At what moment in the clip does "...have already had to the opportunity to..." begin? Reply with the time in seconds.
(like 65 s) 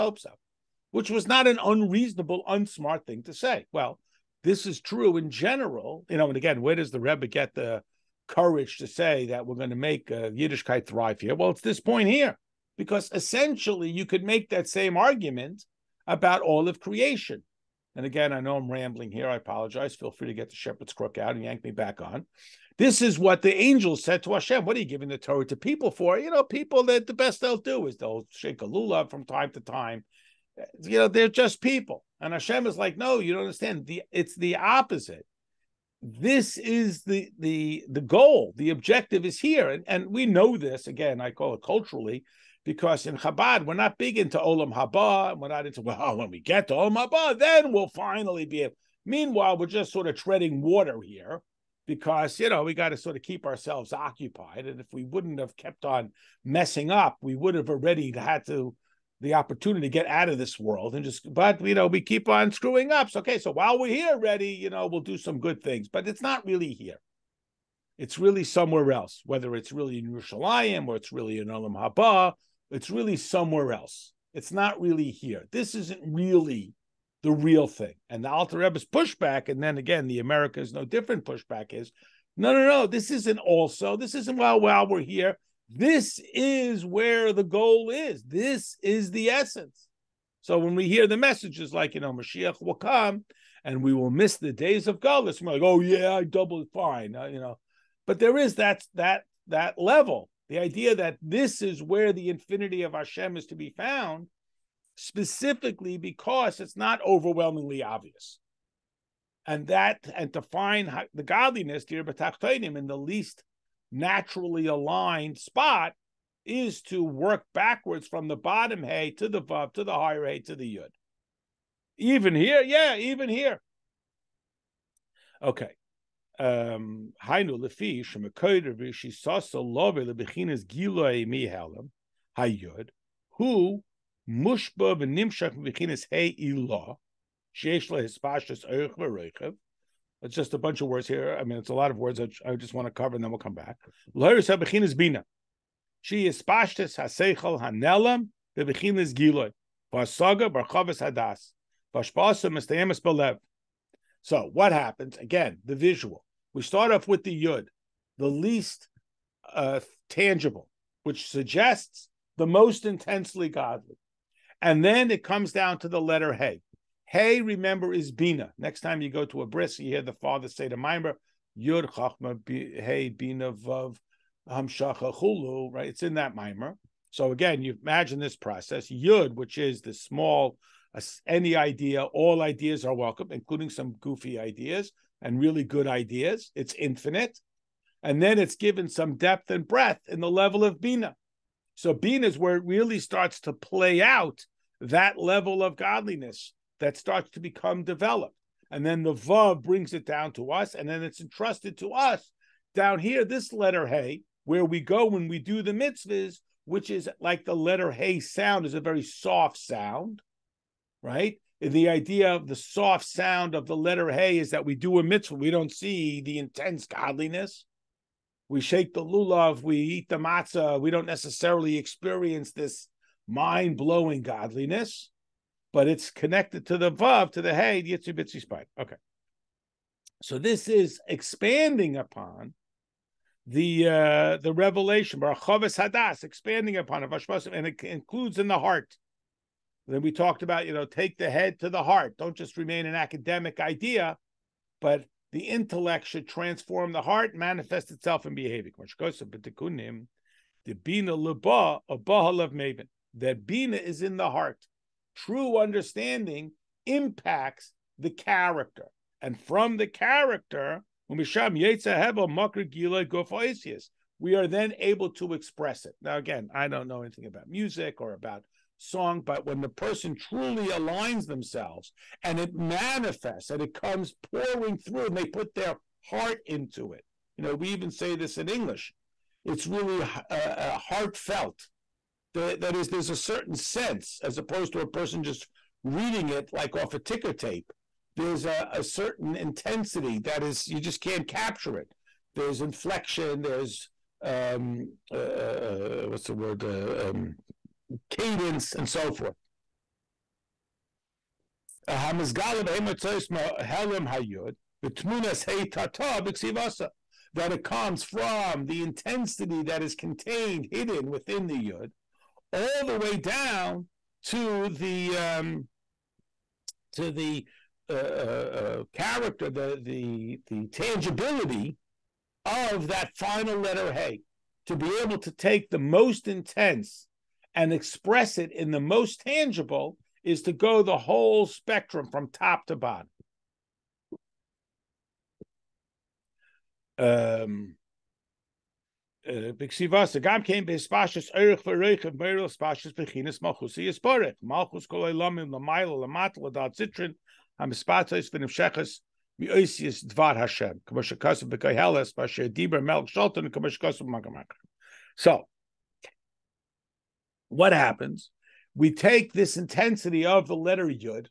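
57 s.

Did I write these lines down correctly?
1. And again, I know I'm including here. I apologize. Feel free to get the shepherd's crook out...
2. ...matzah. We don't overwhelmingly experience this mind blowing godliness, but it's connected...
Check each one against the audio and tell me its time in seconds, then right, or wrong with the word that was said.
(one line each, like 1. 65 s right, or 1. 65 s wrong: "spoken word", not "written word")
1. 17 s wrong: "rambling", not "including"
2. 220 s wrong: "necessarily", not "overwhelmingly".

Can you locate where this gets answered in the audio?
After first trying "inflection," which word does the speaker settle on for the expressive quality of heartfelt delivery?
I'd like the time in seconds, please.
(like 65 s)
298 s.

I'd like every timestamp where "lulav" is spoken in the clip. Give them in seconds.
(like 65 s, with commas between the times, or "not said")
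28 s, 219 s.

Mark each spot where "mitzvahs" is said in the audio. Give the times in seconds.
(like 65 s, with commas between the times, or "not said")
205 s, 215 s.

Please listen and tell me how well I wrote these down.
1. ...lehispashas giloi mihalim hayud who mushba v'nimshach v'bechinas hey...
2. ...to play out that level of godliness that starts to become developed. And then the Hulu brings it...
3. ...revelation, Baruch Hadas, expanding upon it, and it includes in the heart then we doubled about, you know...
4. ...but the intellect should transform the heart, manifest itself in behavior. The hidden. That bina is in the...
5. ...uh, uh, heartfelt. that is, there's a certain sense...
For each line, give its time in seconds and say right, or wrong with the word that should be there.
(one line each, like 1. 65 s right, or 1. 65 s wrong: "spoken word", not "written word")
1. 129 s wrong: "lebechinas", not "lehispashas"
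2. 193 s wrong: "Vav", not "Hulu"
3. 234 s wrong: "talked", not "doubled"
4. 244 s wrong: "maven", not "hidden"
5. 280 s right.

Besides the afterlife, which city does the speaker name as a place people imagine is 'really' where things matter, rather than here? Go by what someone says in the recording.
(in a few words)
Yerushalayim.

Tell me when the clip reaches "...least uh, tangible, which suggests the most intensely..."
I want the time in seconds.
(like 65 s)
158 s.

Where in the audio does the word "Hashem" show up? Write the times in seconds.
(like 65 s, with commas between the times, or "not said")
24 s, 32 s, 102 s.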